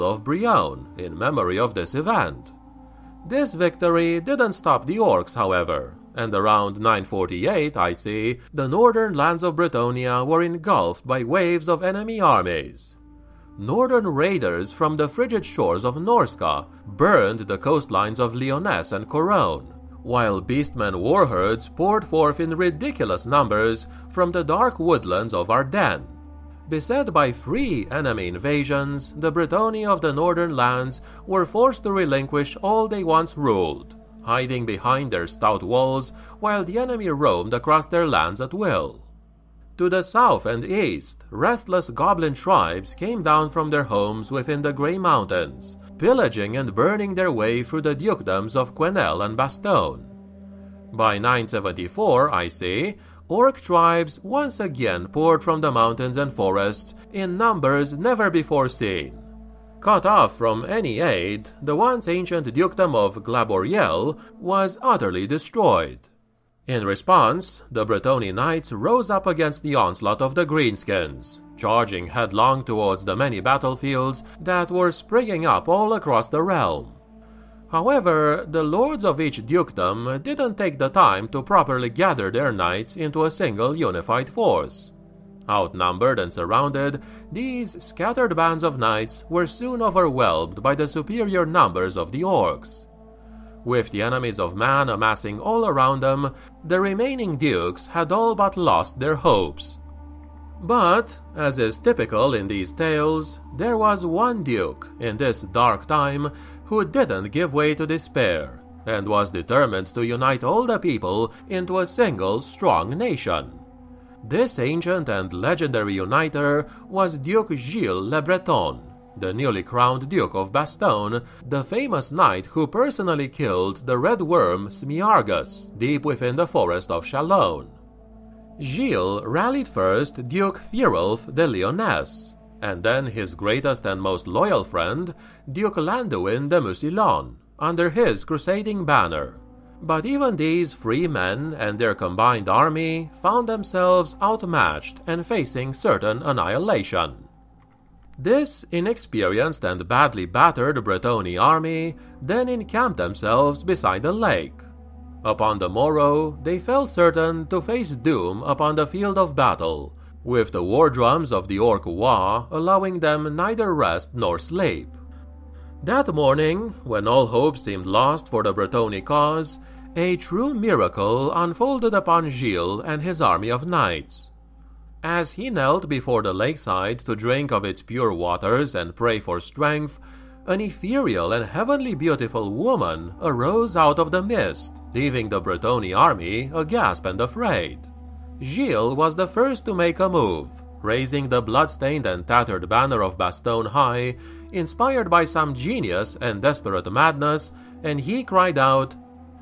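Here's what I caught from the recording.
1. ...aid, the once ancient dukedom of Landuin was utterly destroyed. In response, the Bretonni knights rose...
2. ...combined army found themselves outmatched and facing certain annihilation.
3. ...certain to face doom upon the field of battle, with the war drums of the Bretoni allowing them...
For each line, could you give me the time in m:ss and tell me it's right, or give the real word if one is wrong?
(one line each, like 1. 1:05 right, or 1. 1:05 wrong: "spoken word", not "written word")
1. 1:00 wrong: "Glanborielle", not "Landuin"
2. 2:21 right
3. 2:36 wrong: "Waaagh", not "Bretoni".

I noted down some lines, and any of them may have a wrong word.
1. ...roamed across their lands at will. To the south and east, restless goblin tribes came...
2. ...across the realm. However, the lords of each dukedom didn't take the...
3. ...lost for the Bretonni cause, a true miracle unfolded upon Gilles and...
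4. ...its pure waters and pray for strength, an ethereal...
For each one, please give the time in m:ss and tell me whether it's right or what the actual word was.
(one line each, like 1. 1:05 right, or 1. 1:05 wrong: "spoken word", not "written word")
1. 0:37 right
2. 1:15 right
3. 2:47 right
4. 2:57 right.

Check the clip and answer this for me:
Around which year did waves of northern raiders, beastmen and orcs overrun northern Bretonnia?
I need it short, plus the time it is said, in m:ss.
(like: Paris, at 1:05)
948 IC, at 0:06.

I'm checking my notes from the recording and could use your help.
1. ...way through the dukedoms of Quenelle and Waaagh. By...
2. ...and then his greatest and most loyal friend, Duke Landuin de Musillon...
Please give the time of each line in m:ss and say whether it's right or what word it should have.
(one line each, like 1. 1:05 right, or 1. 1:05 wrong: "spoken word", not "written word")
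1. 0:47 wrong: "Bastonne", not "Waaagh"
2. 2:12 right.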